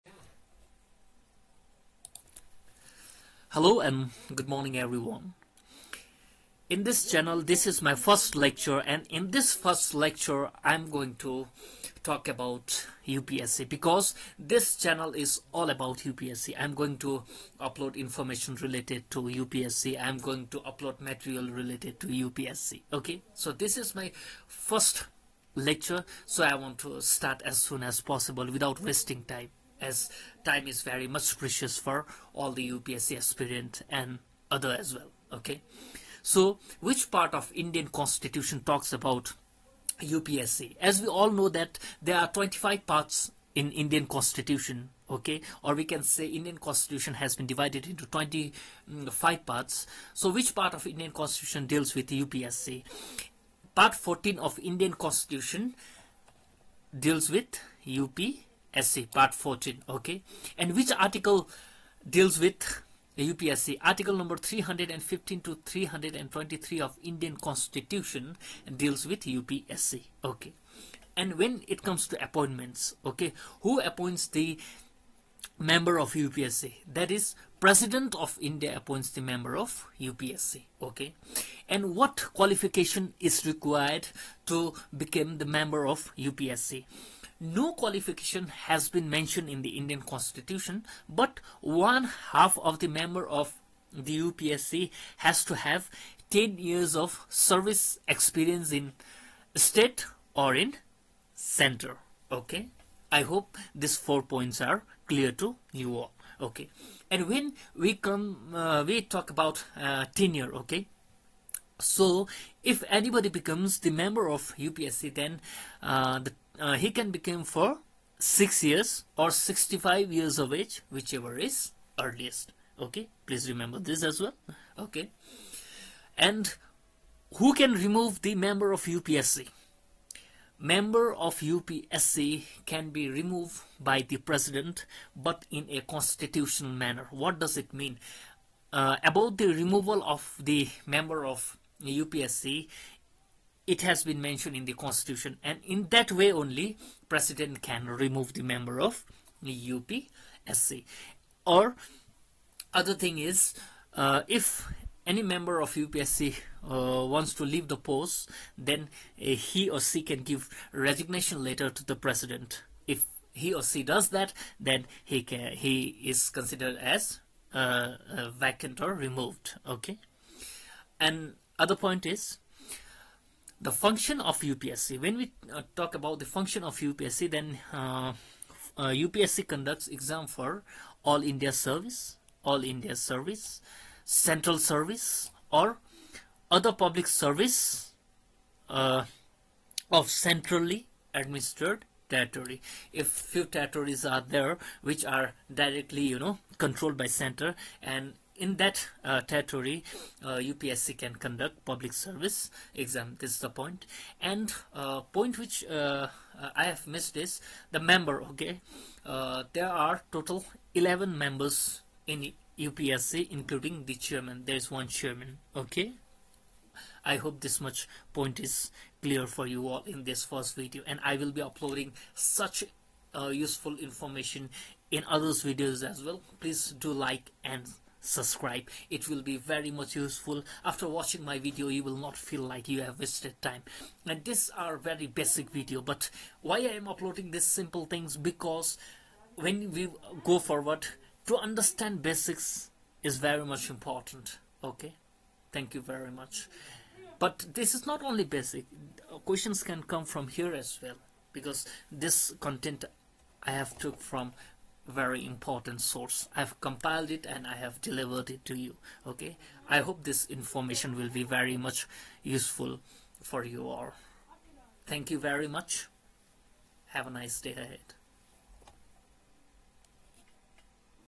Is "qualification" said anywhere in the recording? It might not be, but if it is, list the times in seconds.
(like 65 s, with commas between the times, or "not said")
82 s, 87 s.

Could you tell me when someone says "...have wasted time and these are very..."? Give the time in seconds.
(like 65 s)
232 s.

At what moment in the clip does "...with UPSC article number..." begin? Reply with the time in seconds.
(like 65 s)
62 s.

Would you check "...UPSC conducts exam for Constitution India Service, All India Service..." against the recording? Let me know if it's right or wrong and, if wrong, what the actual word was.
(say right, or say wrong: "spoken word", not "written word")
wrong: "All", not "Constitution".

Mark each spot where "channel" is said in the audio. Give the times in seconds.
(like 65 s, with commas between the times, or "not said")
7 s, 14 s.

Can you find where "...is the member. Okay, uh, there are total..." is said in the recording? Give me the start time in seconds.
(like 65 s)
207 s.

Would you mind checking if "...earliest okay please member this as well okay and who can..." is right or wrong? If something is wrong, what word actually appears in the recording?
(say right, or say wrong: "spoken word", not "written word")
wrong: "remember", not "member".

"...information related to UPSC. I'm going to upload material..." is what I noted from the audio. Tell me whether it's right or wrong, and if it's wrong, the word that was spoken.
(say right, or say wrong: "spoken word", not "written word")
right.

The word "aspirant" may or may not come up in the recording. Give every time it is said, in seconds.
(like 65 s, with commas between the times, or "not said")
33 s.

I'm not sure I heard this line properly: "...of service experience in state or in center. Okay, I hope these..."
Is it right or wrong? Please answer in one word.
right.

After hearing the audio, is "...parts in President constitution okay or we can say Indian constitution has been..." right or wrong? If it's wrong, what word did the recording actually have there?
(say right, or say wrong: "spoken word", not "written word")
wrong: "Indian", not "President".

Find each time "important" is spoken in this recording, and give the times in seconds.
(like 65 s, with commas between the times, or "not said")
243 s, 255 s.